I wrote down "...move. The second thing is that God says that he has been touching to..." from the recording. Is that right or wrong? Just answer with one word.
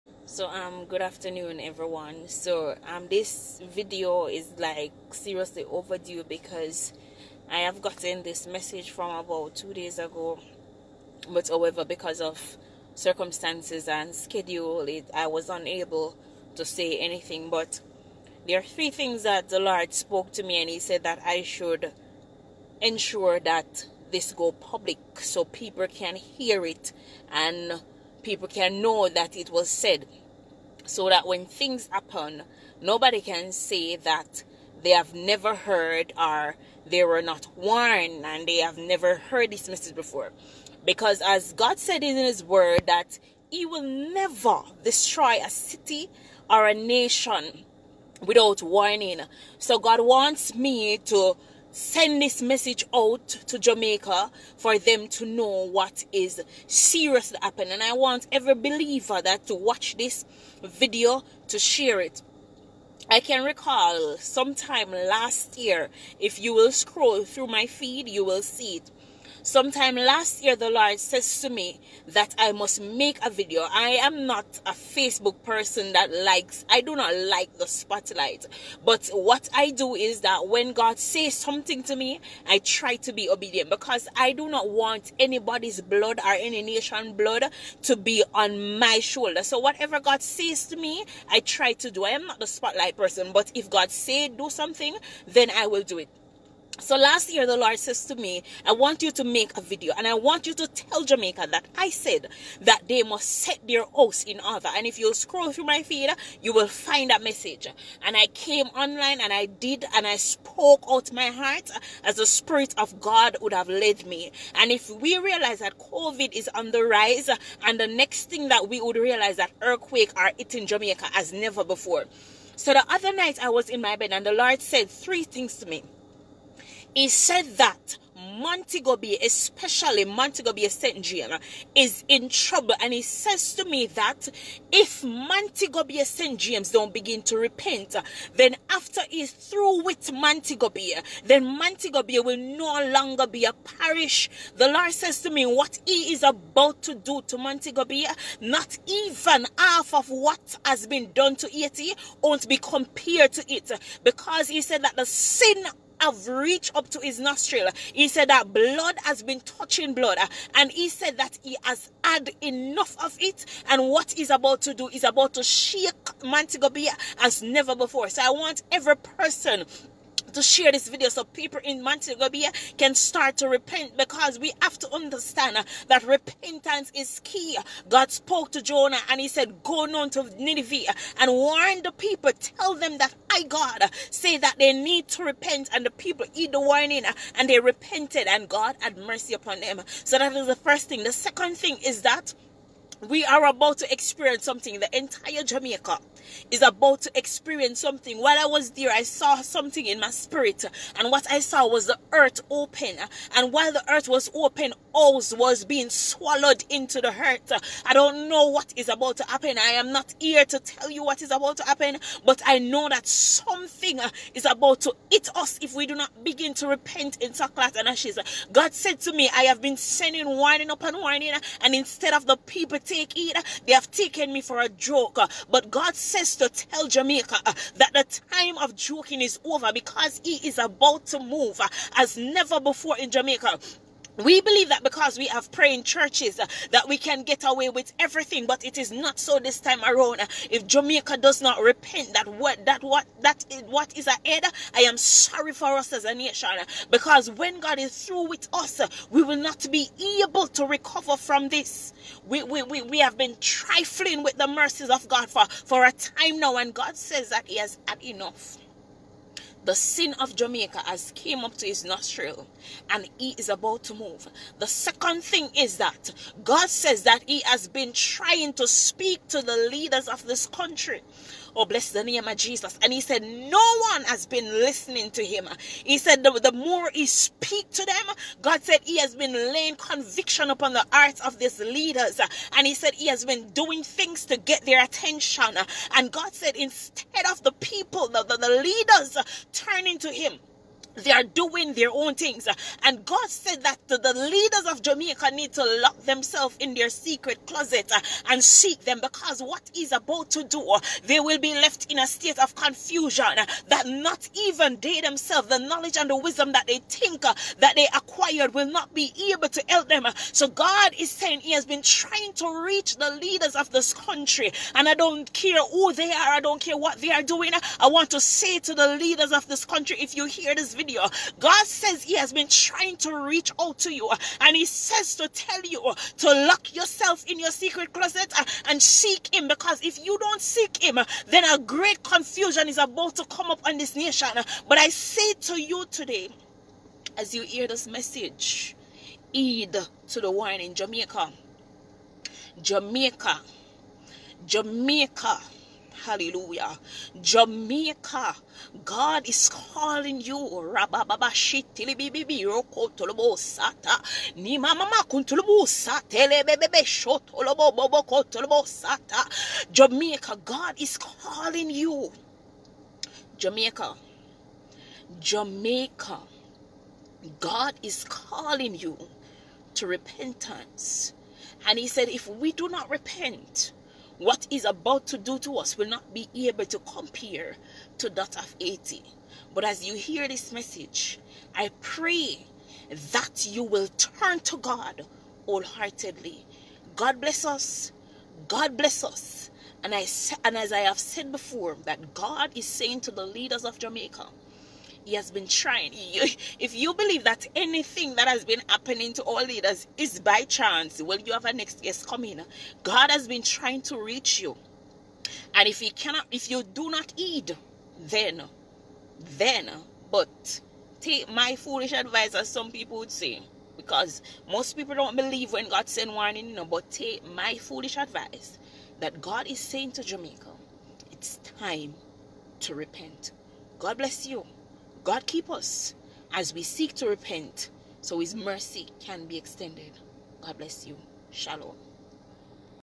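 wrong.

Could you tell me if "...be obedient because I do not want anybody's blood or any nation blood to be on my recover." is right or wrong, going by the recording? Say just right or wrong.
wrong.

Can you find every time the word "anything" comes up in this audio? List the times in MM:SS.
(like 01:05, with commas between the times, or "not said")
00:16, 06:37.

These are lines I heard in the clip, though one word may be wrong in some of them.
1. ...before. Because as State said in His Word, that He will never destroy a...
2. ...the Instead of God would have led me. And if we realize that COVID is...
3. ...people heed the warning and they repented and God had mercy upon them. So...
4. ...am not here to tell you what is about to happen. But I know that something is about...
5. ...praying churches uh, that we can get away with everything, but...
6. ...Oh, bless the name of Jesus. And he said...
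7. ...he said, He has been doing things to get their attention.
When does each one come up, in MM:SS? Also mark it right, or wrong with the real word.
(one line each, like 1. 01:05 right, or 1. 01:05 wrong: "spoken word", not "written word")
1. 00:39 wrong: "God", not "State"
2. 01:52 wrong: "Spirit", not "Instead"
3. 03:05 right
4. 03:29 right
5. 03:55 right
6. 04:31 right
7. 04:42 right.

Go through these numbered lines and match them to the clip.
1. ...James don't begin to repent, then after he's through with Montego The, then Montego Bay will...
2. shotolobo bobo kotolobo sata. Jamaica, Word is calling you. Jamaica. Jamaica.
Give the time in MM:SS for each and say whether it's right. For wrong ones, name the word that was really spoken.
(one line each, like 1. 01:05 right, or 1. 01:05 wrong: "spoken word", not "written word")
1. 02:16 wrong: "Bay", not "The"
2. 05:56 wrong: "God", not "Word".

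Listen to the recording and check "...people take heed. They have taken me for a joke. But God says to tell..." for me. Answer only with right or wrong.
right.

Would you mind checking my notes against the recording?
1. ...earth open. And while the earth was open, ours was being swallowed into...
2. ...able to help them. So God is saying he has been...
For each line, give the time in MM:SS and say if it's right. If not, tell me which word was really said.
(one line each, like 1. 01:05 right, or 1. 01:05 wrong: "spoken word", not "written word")
1. 03:22 right
2. 05:09 right.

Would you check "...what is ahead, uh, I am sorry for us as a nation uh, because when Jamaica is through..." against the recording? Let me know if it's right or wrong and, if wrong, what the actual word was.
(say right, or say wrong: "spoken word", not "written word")
wrong: "God", not "Jamaica".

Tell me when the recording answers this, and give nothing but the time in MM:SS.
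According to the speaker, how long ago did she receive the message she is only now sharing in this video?
00:09.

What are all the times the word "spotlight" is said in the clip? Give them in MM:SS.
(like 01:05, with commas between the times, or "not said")
01:17, 01:32.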